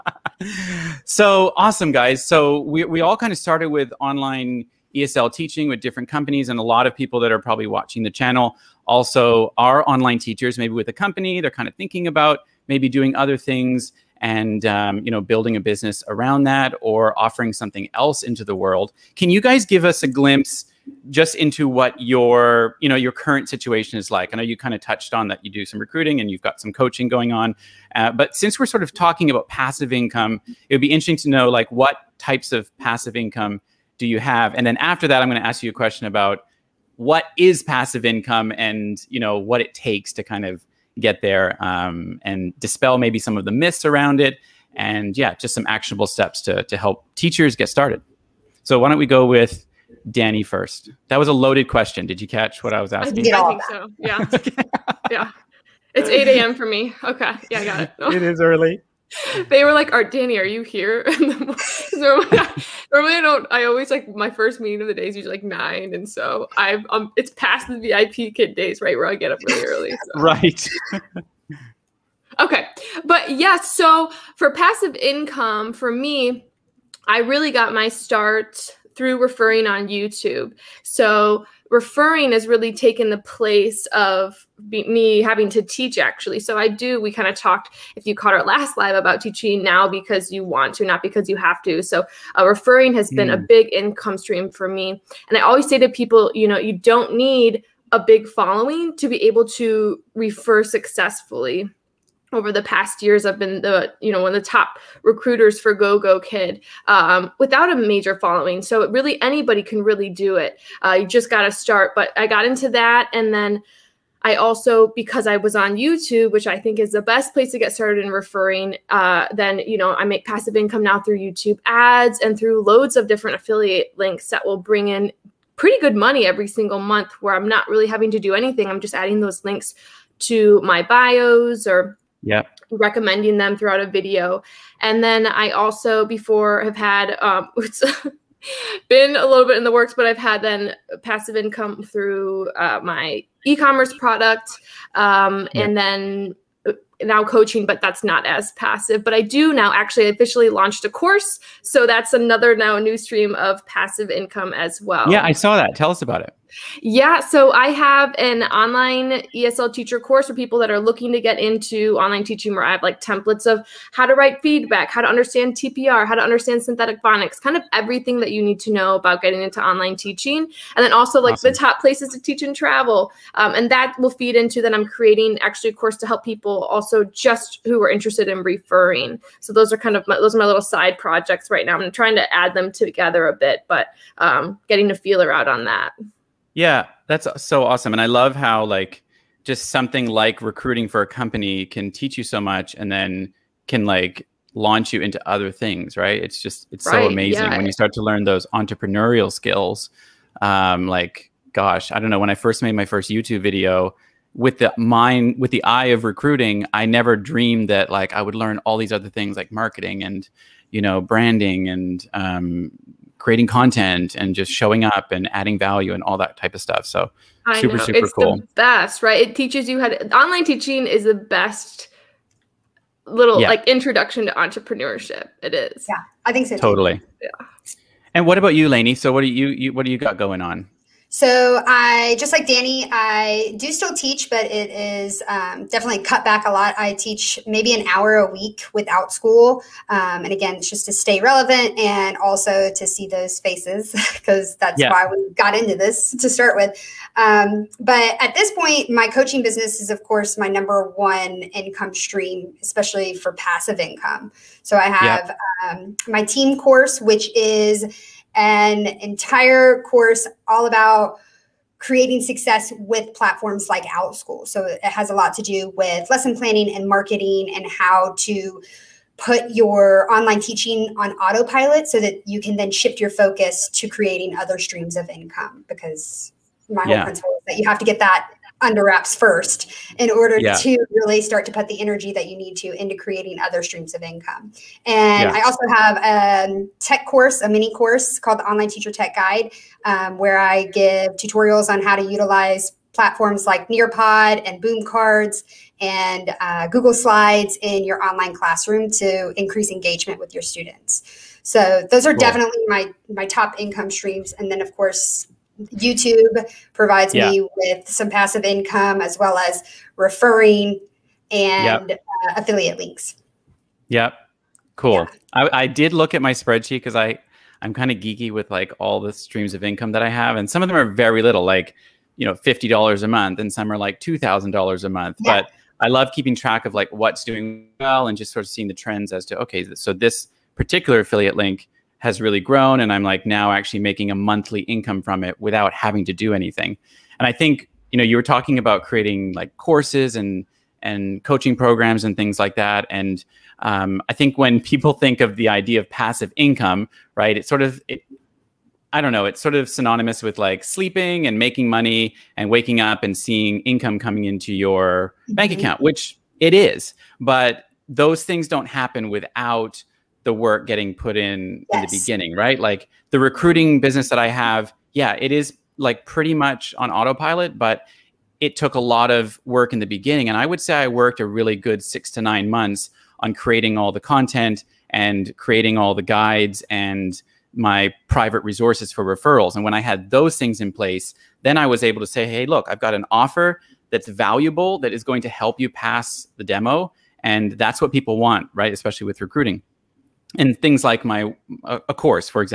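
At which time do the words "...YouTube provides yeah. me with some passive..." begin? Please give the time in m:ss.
5:05.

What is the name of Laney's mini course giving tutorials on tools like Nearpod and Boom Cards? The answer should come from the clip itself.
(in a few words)
Online Teacher Tech Guide.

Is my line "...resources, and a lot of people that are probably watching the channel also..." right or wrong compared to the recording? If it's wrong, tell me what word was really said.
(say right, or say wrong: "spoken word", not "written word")
wrong: "companies", not "resources".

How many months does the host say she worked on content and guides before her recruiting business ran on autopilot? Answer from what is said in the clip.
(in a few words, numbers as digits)
6 to 9 months.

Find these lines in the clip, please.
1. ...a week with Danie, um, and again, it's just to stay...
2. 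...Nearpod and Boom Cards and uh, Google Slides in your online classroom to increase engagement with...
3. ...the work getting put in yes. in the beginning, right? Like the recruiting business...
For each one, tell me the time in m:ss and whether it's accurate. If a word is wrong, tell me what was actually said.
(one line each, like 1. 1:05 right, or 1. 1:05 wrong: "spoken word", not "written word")
1. 3:58 wrong: "Outschool", not "Danie"
2. 4:53 right
3. 6:00 right.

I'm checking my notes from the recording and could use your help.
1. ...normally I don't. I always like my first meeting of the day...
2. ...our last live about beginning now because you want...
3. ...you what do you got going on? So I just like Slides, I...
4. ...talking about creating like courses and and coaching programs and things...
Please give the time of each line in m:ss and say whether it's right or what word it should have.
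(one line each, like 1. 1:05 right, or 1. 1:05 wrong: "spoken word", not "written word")
1. 1:02 right
2. 1:28 wrong: "teaching", not "beginning"
3. 3:49 wrong: "Danie", not "Slides"
4. 5:38 right.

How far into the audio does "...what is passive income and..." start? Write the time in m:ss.
0:36.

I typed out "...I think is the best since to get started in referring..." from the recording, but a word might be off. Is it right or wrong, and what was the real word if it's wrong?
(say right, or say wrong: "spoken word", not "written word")
wrong: "place", not "since".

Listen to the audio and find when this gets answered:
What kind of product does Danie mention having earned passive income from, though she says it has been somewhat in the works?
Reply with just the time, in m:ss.
2:23.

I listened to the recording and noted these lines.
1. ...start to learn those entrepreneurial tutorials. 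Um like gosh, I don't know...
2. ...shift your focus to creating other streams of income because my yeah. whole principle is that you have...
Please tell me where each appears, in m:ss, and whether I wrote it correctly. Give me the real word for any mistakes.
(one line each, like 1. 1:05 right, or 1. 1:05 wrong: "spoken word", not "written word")
1. 3:17 wrong: "skills", not "tutorials"
2. 4:32 right.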